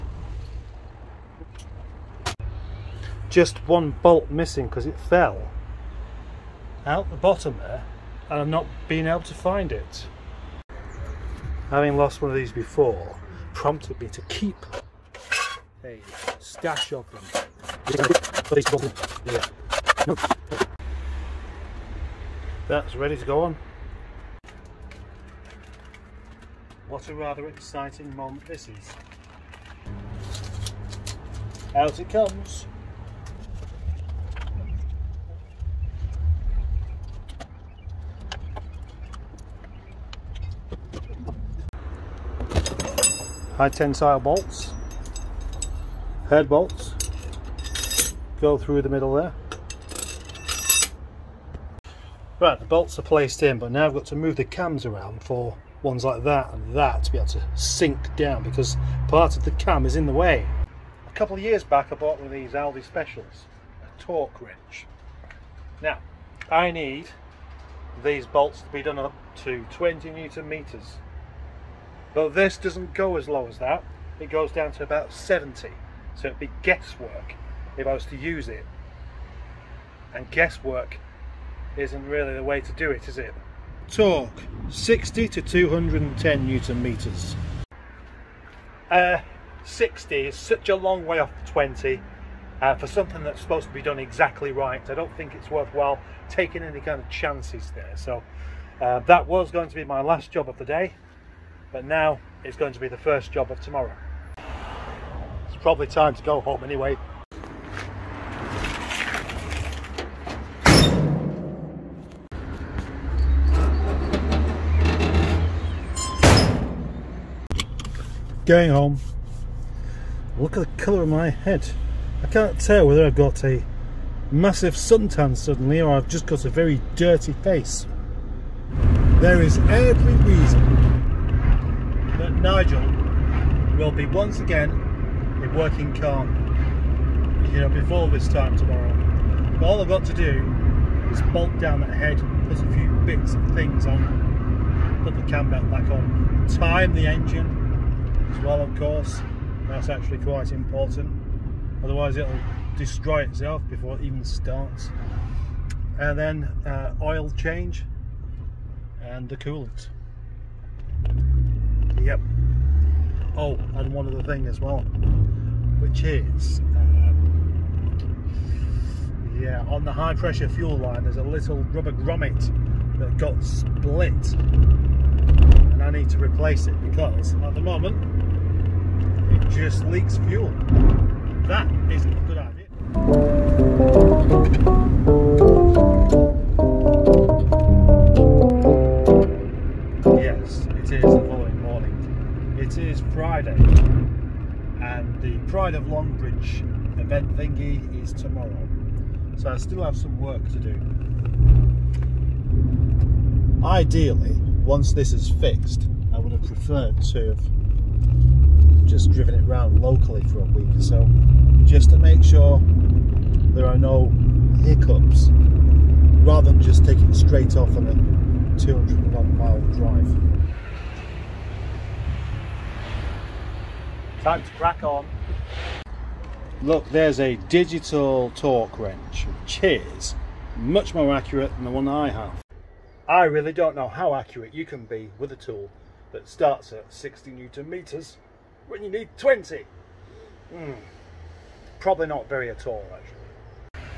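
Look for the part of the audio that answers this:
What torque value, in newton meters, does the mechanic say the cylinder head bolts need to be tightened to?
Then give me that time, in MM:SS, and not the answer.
01:09.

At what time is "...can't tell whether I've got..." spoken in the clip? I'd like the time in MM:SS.
02:02.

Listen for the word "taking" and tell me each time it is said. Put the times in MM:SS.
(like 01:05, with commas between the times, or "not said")
01:36, 03:36.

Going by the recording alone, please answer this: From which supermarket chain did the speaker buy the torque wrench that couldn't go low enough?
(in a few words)
Aldi.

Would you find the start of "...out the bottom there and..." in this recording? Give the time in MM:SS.
00:06.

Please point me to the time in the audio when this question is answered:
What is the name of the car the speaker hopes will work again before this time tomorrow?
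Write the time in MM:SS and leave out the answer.
02:12.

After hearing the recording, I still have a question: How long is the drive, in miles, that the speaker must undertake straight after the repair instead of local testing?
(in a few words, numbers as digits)
201 miles.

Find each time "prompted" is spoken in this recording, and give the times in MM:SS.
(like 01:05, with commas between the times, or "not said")
00:13.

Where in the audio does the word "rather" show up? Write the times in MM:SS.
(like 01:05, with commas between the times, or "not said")
00:27, 03:36.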